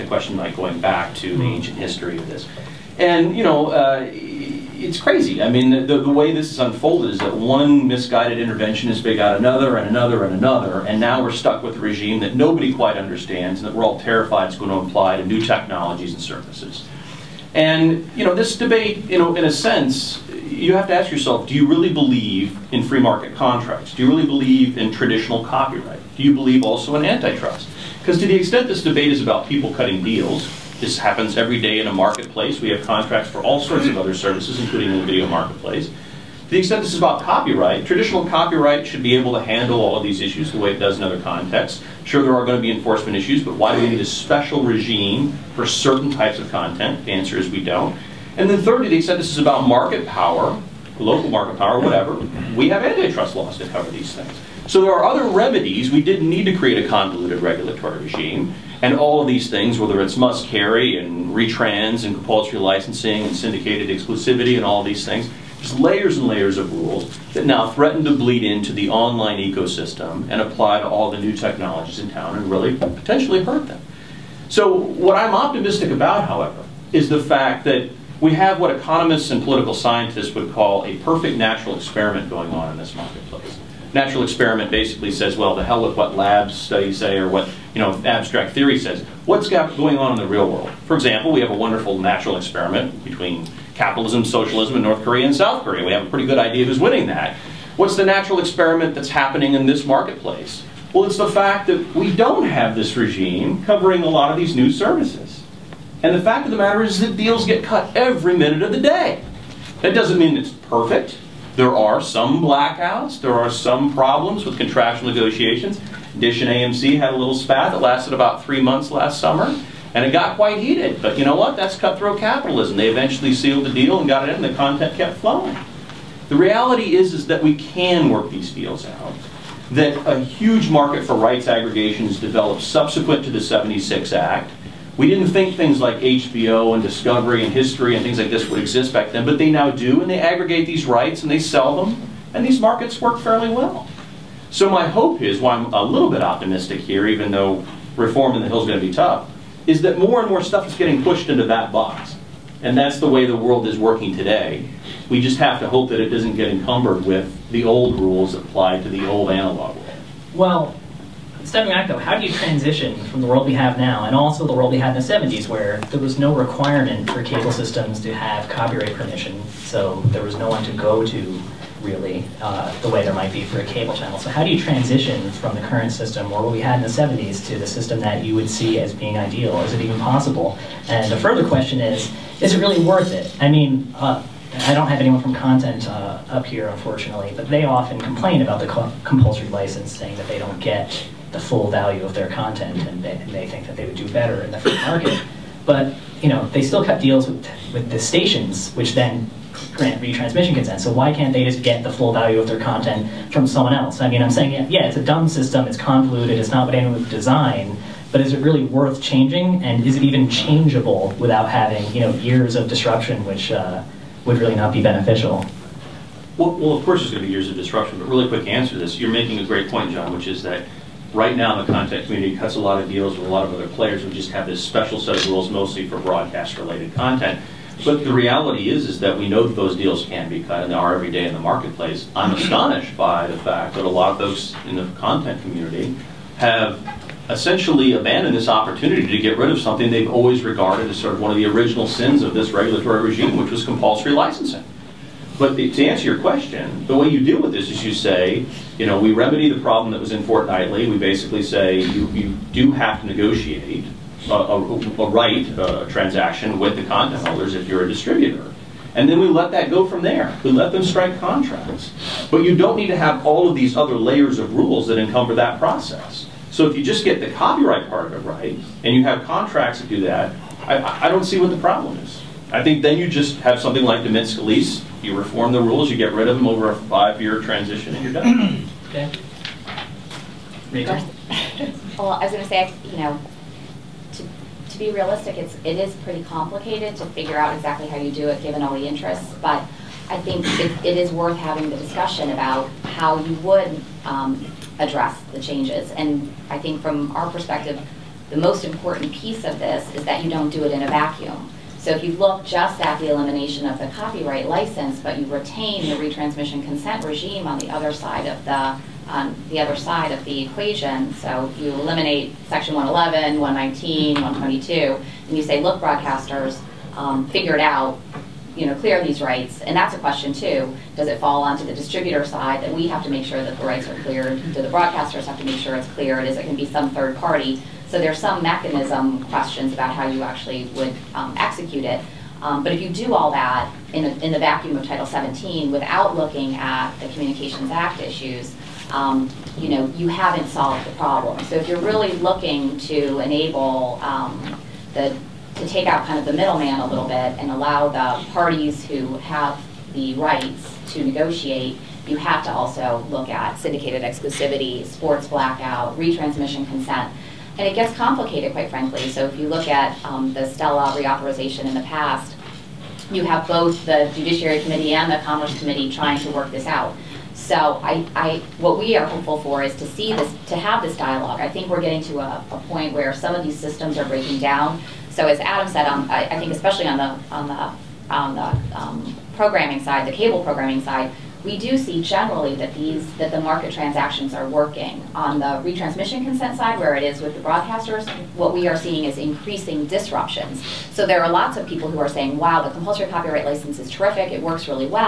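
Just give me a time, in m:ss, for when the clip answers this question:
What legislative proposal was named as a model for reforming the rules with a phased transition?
4:34.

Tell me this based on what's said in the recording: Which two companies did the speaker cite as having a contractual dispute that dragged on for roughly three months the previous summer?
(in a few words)
Dish and AMC.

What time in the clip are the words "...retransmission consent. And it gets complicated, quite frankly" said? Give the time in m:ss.
5:55.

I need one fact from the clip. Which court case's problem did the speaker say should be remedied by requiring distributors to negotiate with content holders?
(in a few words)
Fortnightly.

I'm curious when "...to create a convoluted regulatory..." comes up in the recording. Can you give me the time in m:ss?
0:56.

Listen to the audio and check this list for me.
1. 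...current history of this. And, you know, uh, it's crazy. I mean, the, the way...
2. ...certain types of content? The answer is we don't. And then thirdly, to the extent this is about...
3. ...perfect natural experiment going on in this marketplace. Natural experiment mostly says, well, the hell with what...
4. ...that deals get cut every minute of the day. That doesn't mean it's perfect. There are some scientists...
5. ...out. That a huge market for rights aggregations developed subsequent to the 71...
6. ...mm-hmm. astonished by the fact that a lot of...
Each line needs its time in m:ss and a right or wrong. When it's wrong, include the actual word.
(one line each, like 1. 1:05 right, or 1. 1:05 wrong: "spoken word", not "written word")
1. 0:01 wrong: "ancient", not "current"
2. 0:45 right
3. 1:20 wrong: "basically", not "mostly"
4. 1:46 wrong: "blackouts", not "scientists"
5. 2:08 wrong: "76", not "71"
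6. 3:52 right.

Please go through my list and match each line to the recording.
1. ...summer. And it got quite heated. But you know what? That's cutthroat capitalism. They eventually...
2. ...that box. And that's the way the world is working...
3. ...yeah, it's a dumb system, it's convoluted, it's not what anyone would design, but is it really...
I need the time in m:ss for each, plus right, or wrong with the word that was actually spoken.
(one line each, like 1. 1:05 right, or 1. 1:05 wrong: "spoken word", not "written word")
1. 1:59 right
2. 2:31 right
3. 3:24 right.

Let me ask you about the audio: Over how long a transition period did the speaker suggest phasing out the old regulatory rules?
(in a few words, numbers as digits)
5 years.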